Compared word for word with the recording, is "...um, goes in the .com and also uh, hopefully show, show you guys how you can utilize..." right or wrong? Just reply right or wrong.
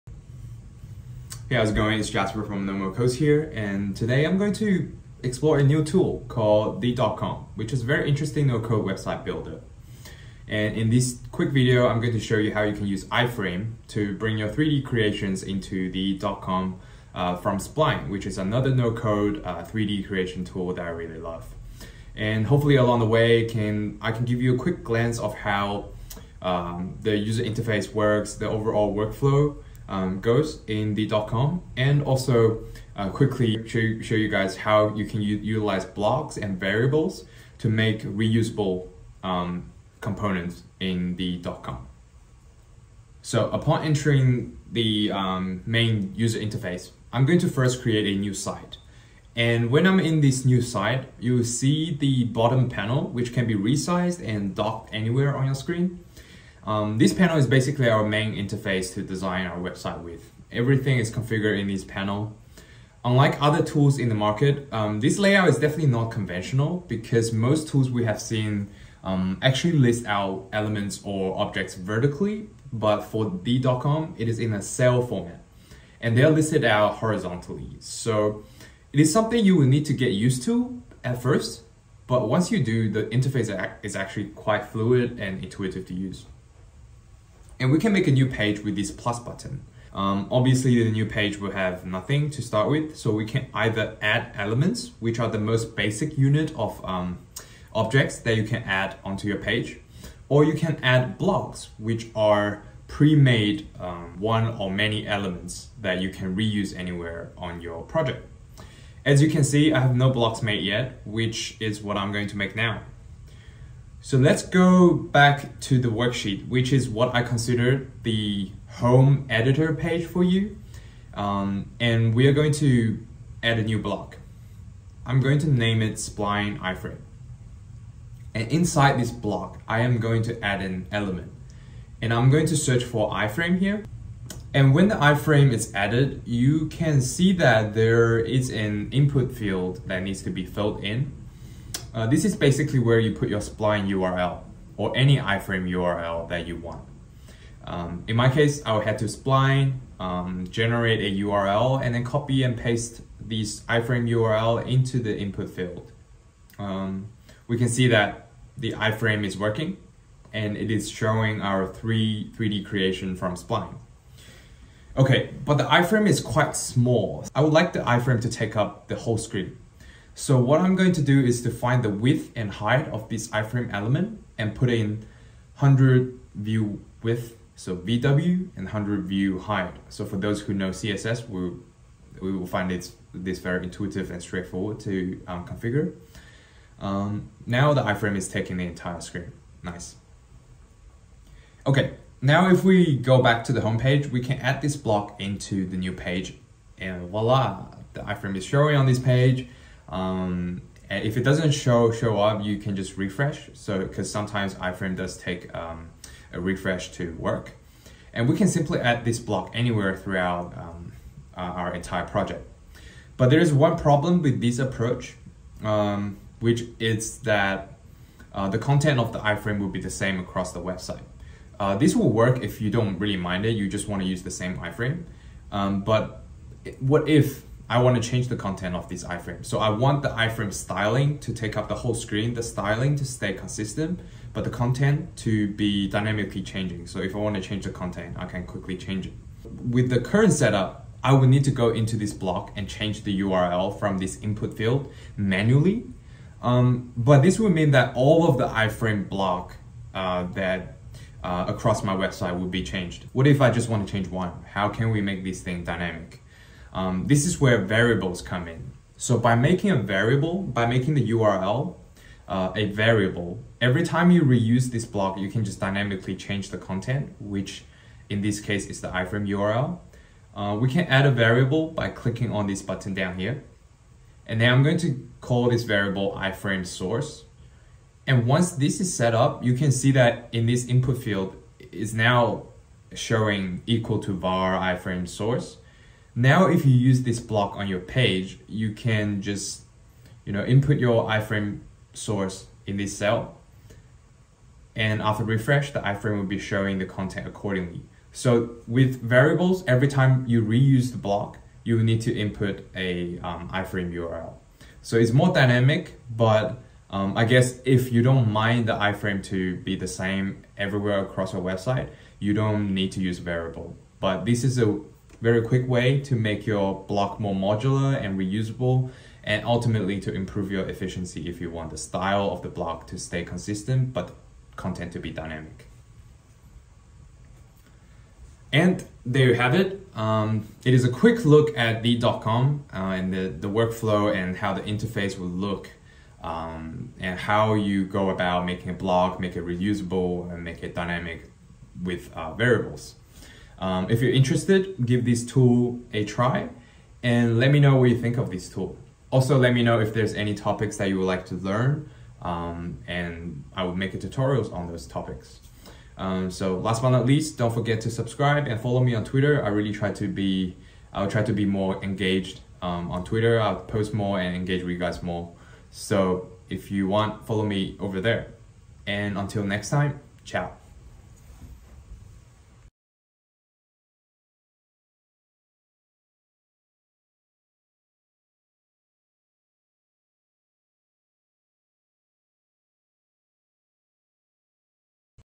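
wrong.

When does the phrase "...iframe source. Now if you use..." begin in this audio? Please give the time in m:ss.
4:44.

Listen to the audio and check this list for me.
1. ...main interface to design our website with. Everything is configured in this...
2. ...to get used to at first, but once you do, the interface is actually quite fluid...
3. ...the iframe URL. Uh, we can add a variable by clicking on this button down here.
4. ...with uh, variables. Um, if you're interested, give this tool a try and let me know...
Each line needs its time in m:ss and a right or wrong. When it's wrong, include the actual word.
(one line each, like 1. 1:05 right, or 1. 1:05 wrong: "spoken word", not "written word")
1. 0:58 right
2. 1:19 right
3. 4:28 right
4. 5:41 right.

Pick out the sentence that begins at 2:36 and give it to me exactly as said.
Um, we can see that the iframe is working and it is showing our three 3D creation from spline.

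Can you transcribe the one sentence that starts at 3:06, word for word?
Um, now the iframe is taking the entire screen.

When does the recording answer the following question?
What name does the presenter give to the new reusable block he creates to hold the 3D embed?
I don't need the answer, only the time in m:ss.
2:05.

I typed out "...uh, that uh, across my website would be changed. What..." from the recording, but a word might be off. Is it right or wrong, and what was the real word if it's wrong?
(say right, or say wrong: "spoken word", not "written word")
right.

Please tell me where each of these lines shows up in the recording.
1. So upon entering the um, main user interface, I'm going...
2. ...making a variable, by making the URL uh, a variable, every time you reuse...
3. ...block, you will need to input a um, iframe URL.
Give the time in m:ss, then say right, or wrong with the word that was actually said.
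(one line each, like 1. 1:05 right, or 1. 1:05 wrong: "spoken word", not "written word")
1. 0:43 right
2. 4:19 right
3. 5:00 right.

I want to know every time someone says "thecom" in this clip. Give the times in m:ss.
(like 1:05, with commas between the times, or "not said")
0:06, 0:15, 1:13, 5:31.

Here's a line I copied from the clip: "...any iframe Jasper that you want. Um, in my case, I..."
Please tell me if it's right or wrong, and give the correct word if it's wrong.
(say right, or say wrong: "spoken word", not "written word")
wrong: "URL", not "Jasper".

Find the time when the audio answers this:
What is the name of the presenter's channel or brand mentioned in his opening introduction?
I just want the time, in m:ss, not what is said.
0:02.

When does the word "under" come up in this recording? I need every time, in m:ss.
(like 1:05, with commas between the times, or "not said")
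not said.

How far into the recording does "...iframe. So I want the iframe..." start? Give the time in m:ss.
3:49.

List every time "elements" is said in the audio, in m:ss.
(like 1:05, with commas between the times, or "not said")
1:10, 1:34, 1:45, 2:10, 2:53.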